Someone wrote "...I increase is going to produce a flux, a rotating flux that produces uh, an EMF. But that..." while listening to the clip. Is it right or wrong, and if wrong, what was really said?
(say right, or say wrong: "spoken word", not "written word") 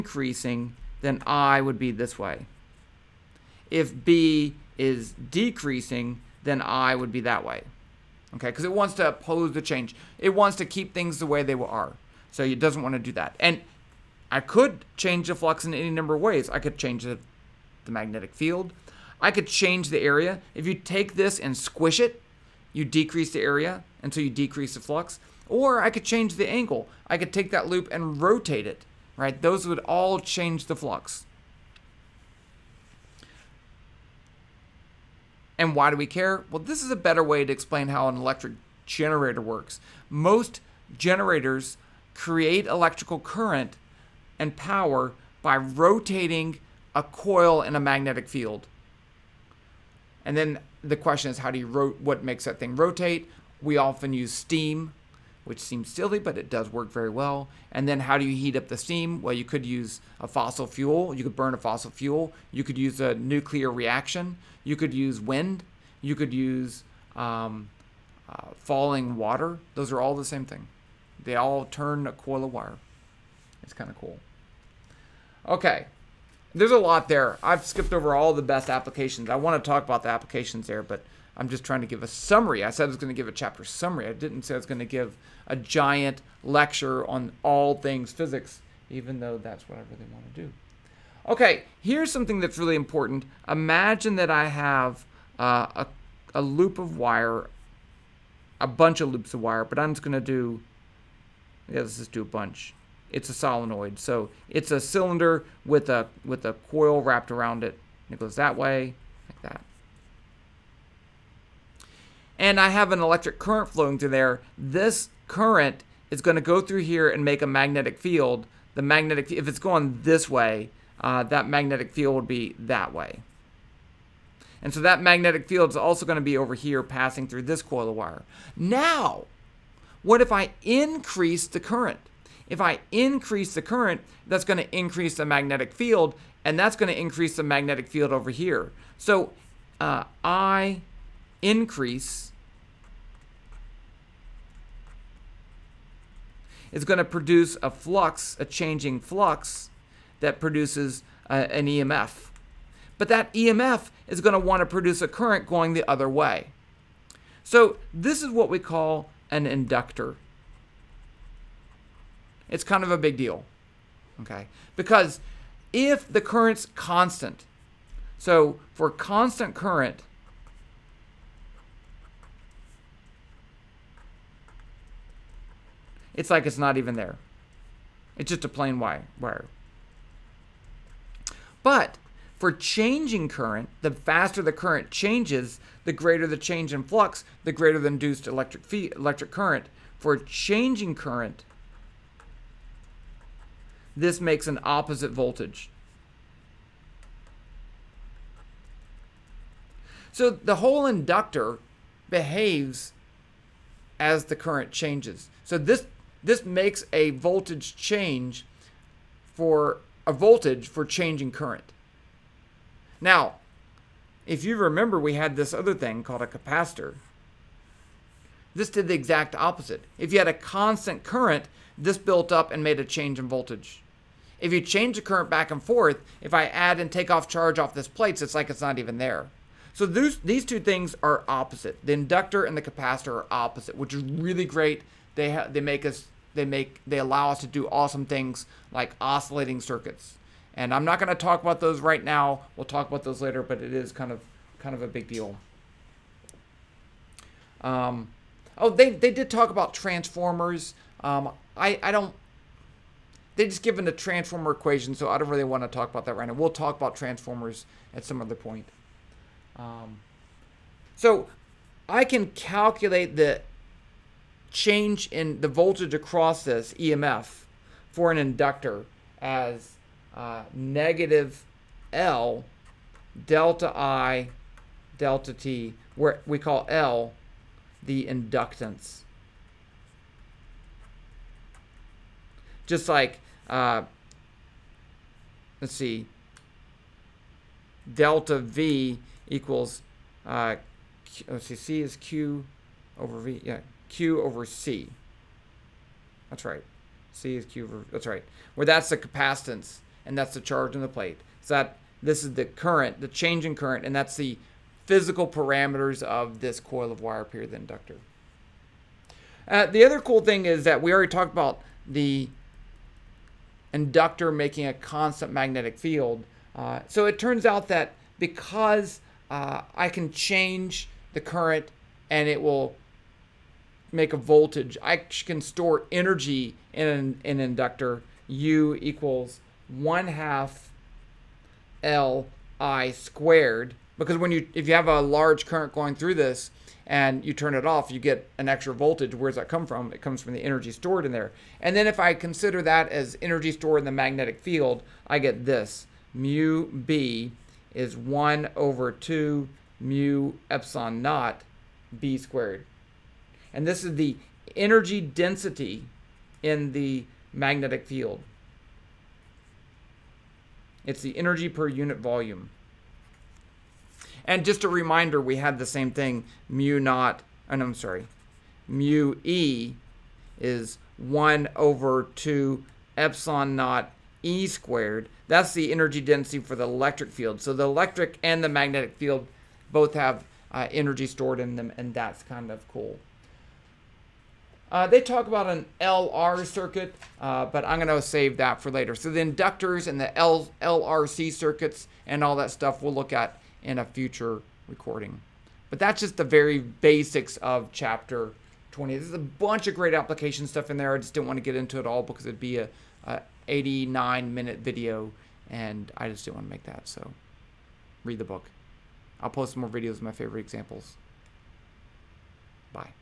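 wrong: "changing", not "rotating".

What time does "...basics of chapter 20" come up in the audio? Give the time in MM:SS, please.
06:36.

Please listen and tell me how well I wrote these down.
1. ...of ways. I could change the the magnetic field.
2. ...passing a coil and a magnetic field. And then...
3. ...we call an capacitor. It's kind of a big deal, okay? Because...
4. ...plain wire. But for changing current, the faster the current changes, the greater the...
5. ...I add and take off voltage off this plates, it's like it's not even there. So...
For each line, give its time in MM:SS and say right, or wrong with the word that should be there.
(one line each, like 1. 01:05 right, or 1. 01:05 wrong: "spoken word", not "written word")
1. 00:16 right
2. 00:45 wrong: "rotating", not "passing"
3. 02:38 wrong: "inductor", not "capacitor"
4. 02:58 right
5. 03:46 wrong: "charge", not "voltage".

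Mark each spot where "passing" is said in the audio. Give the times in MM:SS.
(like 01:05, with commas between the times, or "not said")
02:06.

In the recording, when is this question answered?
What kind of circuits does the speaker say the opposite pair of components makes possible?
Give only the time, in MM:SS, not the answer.
03:59.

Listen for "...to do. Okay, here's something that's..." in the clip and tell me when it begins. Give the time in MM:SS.
01:30.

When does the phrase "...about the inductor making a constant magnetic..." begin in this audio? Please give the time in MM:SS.
05:11.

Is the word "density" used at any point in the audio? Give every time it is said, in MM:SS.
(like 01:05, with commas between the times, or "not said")
05:55, 06:16.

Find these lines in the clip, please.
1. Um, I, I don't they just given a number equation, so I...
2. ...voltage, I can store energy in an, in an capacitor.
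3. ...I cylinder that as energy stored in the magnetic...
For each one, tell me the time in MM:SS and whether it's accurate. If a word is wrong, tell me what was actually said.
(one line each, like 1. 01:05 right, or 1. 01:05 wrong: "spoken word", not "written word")
1. 04:11 wrong: "transformer", not "number"
2. 05:24 wrong: "inductor", not "capacitor"
3. 05:41 wrong: "consider", not "cylinder".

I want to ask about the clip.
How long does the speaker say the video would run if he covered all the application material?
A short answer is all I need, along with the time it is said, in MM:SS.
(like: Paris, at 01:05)
89 minutes, at 06:43.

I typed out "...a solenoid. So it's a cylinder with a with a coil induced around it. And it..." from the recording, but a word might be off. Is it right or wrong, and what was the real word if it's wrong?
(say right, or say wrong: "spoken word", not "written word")
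wrong: "wrapped", not "induced".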